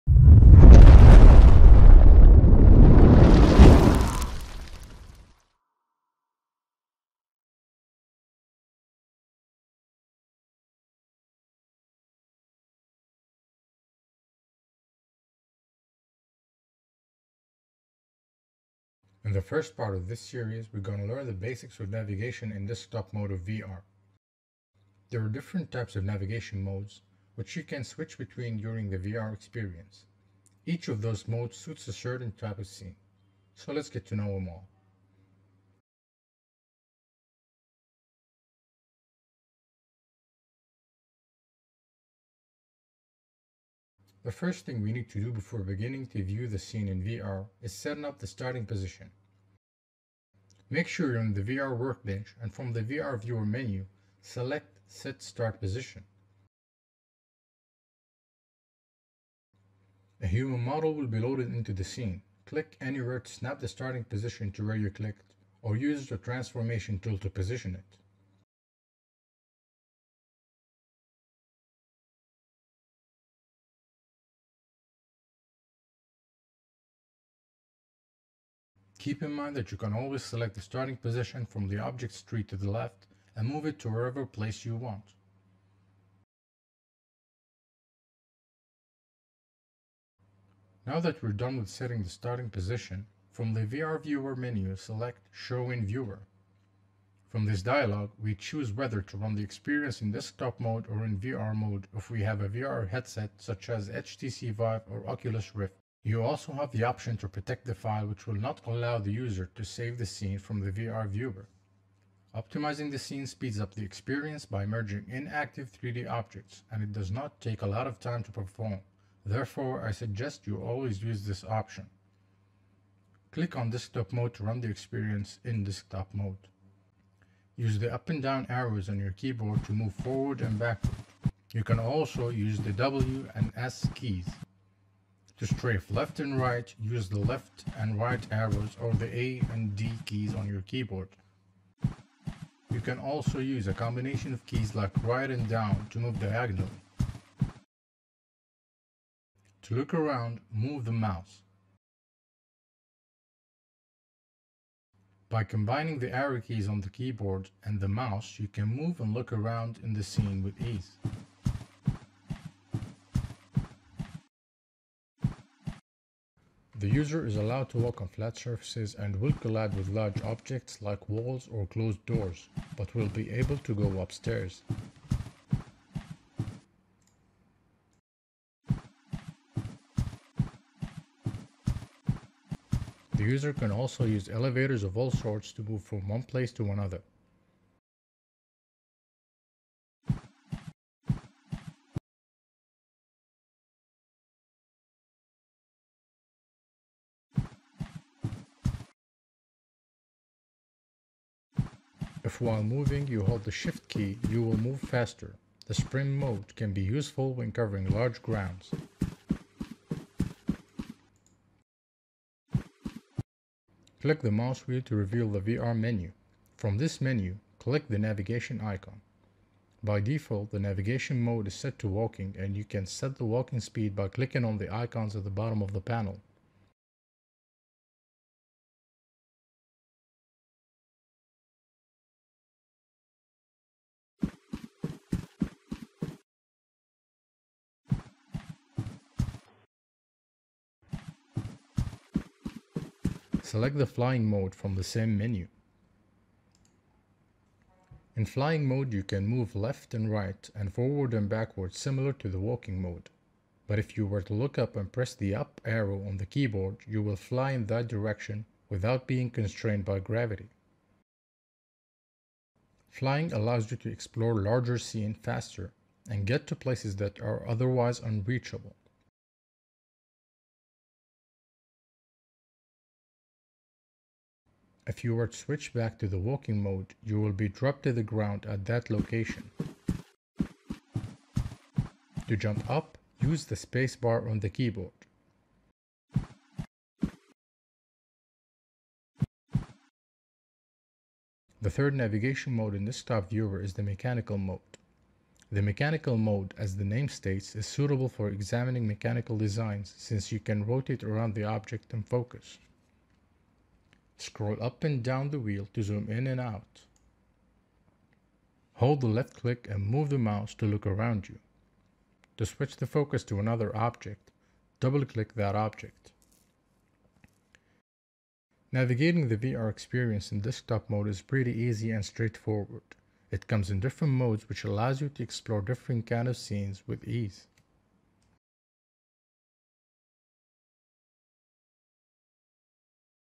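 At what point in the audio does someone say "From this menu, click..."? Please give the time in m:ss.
3:36.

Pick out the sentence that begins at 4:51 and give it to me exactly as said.
The third navigation mode in desktop viewer is the mechanical mode.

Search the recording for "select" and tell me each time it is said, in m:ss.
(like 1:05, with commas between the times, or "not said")
0:54, 1:20, 1:34, 4:03.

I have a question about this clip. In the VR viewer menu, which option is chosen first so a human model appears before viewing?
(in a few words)
Set Start Position.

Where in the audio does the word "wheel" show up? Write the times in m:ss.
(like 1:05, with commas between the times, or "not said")
3:34, 5:05.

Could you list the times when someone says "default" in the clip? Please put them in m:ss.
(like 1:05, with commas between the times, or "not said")
3:39.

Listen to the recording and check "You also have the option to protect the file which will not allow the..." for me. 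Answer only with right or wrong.
right.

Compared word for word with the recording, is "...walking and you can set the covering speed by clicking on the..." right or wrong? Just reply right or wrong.
wrong.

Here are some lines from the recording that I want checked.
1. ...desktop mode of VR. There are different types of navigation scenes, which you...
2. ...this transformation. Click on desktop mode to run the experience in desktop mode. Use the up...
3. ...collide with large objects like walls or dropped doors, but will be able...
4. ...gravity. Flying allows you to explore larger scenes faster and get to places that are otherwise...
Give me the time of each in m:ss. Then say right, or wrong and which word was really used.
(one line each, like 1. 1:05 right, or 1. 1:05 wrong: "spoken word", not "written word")
1. 0:22 wrong: "modes", not "scenes"
2. 2:01 wrong: "option", not "transformation"
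3. 2:49 wrong: "closed", not "dropped"
4. 4:19 right.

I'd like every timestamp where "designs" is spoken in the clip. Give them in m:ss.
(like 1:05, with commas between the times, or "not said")
4:59.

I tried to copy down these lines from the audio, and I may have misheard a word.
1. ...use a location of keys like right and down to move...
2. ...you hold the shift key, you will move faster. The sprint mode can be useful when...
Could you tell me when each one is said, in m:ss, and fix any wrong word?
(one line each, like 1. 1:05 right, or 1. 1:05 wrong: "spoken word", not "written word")
1. 2:23 wrong: "combination", not "location"
2. 3:23 right.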